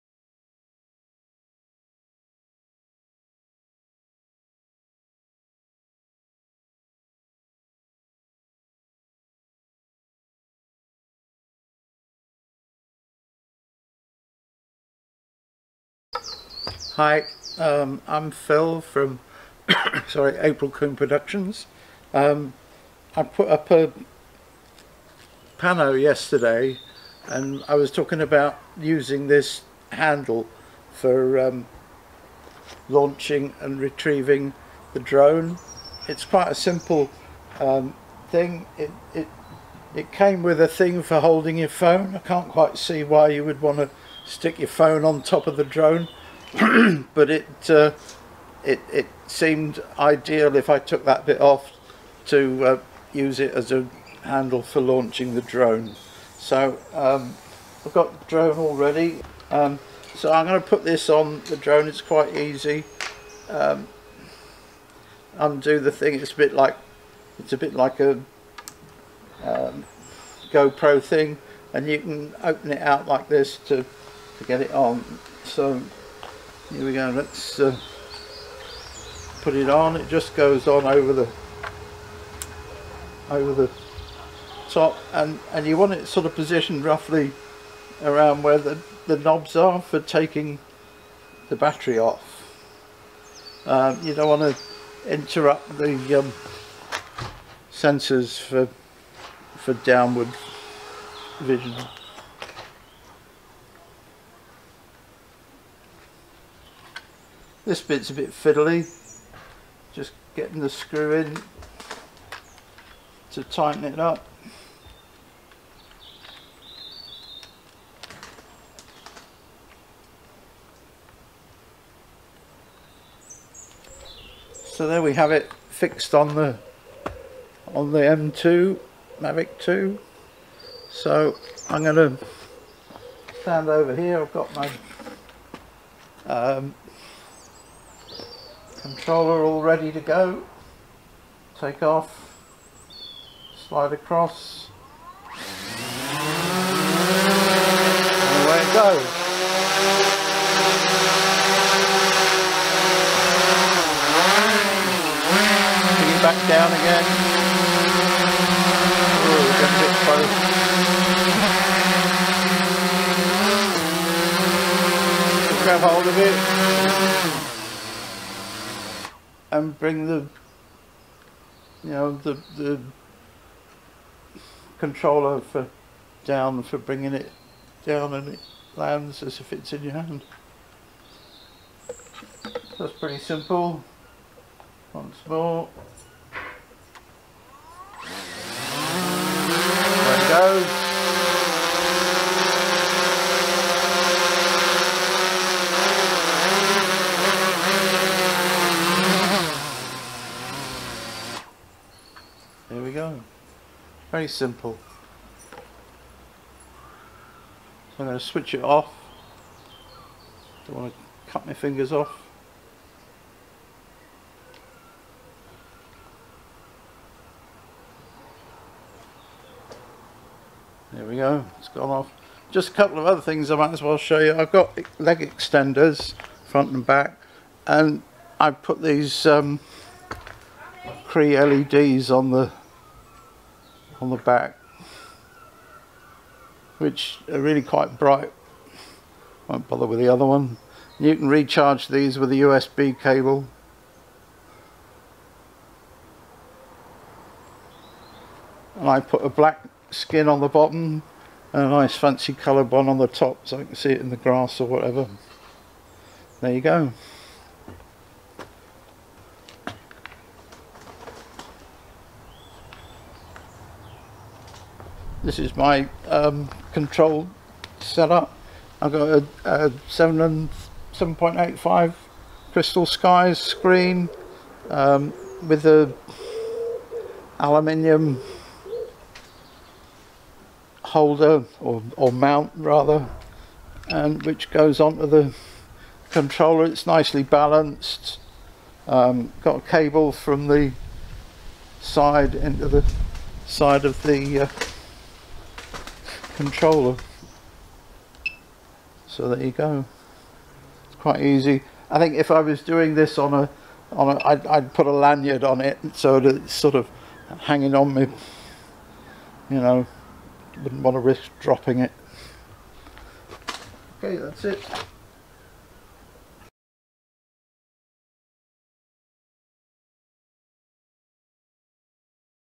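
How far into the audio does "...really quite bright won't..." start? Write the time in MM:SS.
03:57.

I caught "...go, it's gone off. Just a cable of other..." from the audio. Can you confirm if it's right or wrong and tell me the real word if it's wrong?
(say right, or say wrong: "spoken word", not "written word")
wrong: "couple", not "cable".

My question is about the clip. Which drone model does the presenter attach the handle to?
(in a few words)
Mavic 2.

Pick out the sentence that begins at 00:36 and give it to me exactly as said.
It's quite a simple um, thing.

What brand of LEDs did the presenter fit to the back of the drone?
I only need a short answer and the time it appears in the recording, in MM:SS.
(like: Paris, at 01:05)
Cree, at 03:51.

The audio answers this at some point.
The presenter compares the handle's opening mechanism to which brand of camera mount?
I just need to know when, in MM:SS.
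01:10.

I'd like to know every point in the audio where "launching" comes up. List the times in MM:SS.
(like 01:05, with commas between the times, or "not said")
00:32, 00:54.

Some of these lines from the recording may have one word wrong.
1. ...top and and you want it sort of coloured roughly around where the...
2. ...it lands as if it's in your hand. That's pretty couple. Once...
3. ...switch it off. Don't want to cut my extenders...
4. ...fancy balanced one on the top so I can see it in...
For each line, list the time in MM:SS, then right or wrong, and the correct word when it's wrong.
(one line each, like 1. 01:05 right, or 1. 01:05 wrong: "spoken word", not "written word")
1. 01:24 wrong: "positioned", not "coloured"
2. 02:58 wrong: "simple", not "couple"
3. 03:28 wrong: "fingers", not "extenders"
4. 04:11 wrong: "coloured", not "balanced".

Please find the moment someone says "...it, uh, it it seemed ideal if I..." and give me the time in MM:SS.
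00:47.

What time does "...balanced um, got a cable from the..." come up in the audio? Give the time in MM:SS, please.
04:47.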